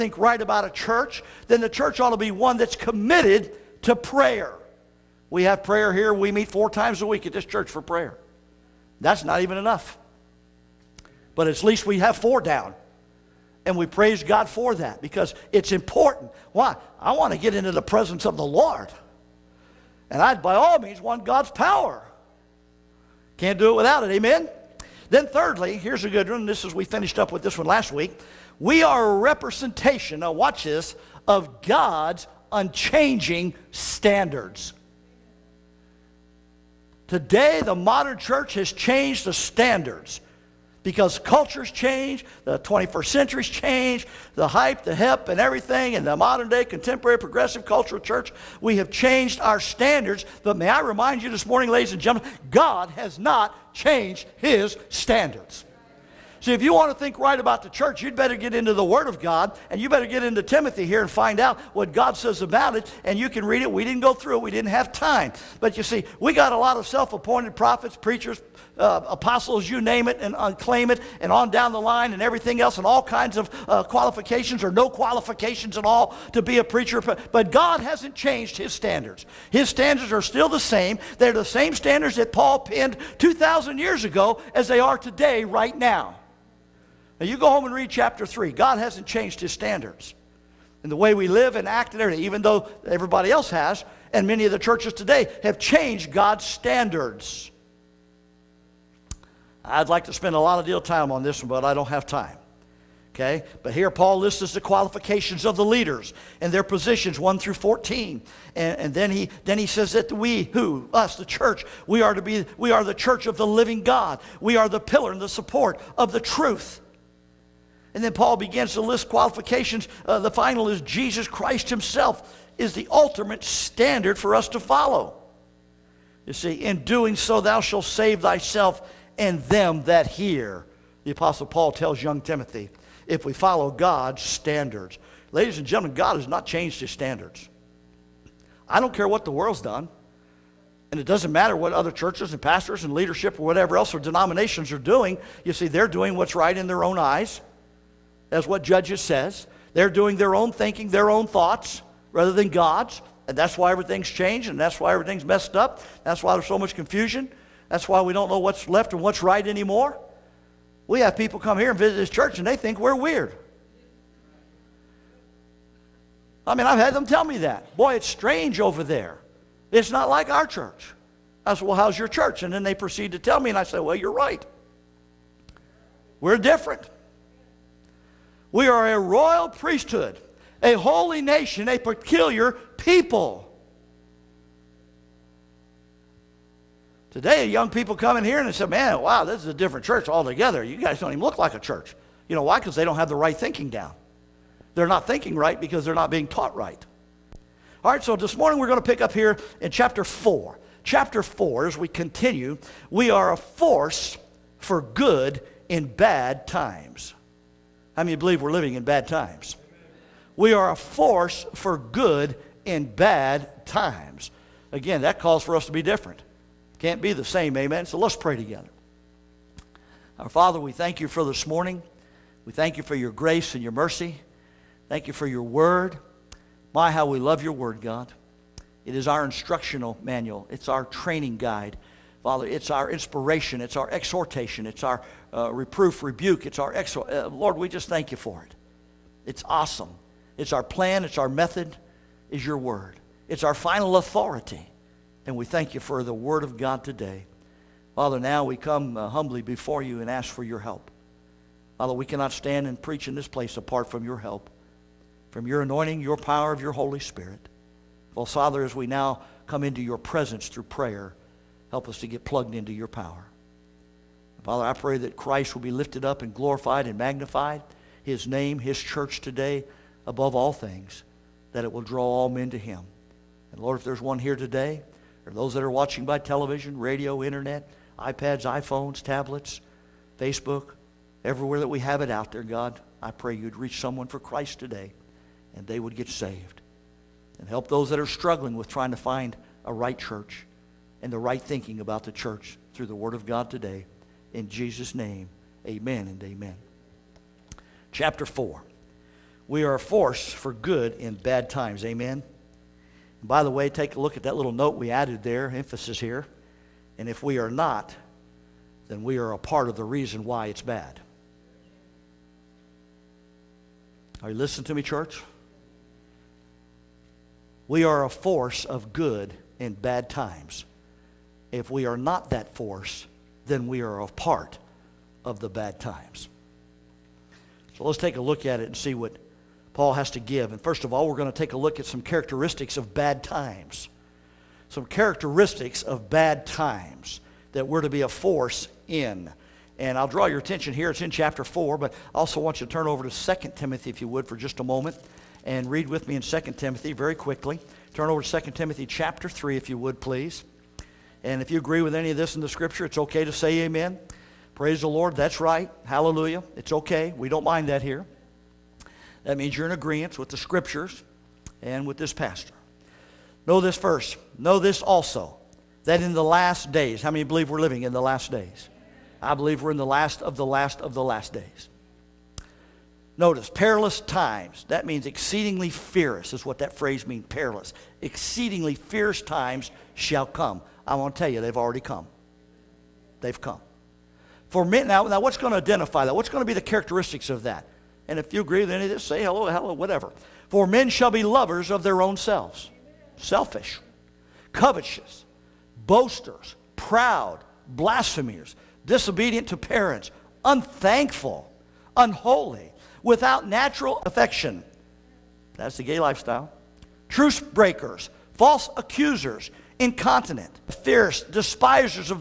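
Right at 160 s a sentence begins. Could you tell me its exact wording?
We have people come here and visit this church, and they think we're weird.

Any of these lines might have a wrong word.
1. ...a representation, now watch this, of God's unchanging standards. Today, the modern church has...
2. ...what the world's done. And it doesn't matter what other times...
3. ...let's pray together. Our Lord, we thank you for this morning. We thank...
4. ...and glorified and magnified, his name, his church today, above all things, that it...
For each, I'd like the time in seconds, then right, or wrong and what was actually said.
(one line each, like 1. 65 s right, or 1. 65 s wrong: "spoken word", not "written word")
1. 29 s right
2. 139 s wrong: "churches", not "times"
3. 217 s wrong: "Father", not "Lord"
4. 266 s right.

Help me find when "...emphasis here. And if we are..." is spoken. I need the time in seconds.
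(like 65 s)
305 s.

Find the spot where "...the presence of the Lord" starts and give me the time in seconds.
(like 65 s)
17 s.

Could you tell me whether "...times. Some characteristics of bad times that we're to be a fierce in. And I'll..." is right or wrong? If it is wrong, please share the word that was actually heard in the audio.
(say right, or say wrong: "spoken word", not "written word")
wrong: "force", not "fierce".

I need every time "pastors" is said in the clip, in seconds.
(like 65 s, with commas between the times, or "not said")
142 s, 362 s.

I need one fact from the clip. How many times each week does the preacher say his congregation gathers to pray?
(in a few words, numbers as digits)
4.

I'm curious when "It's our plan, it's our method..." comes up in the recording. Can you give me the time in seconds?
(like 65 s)
240 s.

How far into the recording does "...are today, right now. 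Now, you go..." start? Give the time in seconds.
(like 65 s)
84 s.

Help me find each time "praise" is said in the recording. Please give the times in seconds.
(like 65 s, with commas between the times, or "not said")
13 s, 354 s.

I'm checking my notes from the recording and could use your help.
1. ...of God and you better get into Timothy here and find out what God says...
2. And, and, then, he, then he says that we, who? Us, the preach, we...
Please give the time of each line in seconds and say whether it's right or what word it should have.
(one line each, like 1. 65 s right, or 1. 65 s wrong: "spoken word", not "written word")
1. 59 s right
2. 108 s wrong: "church", not "preach".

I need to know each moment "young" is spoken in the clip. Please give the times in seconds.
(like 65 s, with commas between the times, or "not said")
132 s, 187 s.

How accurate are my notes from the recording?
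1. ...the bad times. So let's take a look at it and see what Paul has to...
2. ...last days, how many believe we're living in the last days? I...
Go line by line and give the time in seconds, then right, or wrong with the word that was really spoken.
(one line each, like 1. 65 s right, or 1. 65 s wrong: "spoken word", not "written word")
1. 325 s right
2. 366 s right.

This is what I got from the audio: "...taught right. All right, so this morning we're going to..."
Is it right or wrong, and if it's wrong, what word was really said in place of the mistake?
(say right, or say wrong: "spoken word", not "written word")
right.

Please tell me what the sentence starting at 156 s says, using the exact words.
That's why there's so much confusion.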